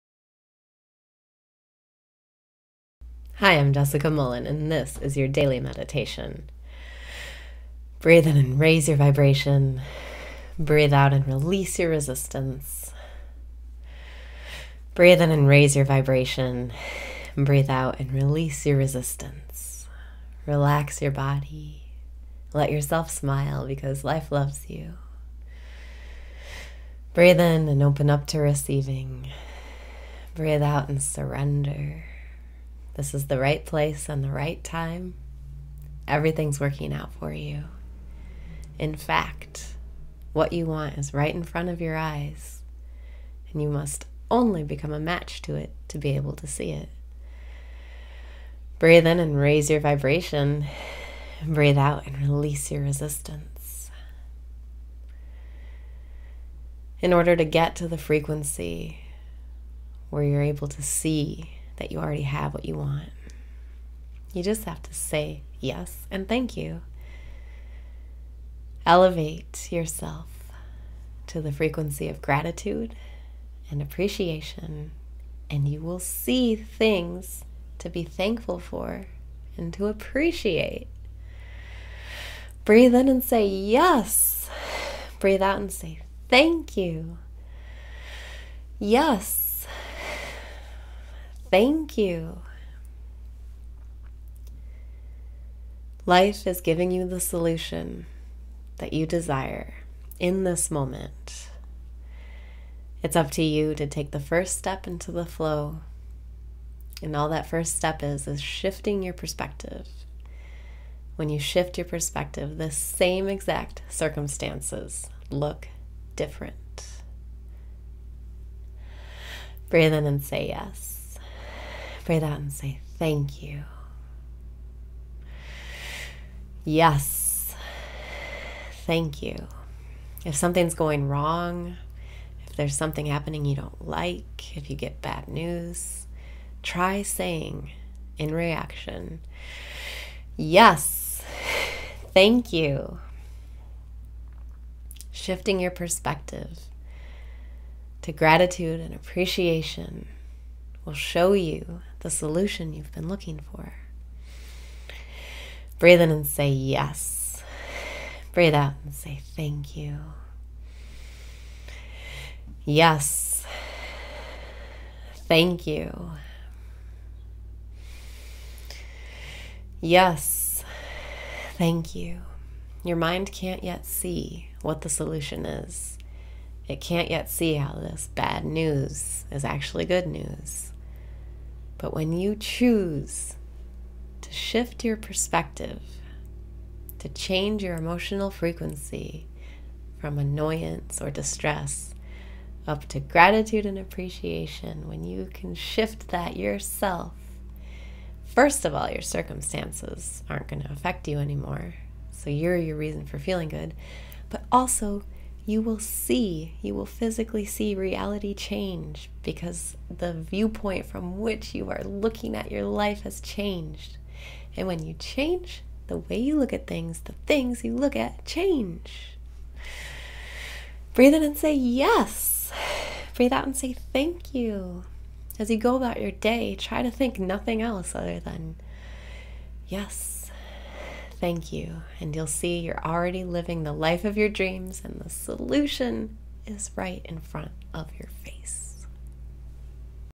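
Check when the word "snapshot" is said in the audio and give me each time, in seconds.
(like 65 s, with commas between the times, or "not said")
not said.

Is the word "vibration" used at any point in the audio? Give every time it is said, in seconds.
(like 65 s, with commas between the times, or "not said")
8 s, 15 s, 49 s.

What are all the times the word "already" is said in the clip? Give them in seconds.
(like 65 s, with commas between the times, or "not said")
61 s, 232 s.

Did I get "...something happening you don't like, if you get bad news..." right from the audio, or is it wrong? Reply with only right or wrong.
right.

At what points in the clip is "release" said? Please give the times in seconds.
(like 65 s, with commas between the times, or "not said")
11 s, 18 s, 52 s.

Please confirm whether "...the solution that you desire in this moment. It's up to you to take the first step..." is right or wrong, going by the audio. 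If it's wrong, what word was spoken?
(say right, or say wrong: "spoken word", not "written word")
right.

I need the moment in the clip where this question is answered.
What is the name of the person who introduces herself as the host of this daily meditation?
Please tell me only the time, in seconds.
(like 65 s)
3 s.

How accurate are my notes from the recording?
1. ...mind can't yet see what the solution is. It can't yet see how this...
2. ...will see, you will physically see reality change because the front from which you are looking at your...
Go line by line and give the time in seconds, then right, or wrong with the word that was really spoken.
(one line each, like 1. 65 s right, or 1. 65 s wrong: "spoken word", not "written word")
1. 172 s right
2. 205 s wrong: "viewpoint", not "front".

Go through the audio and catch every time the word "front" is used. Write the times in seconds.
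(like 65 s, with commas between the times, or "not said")
41 s, 237 s.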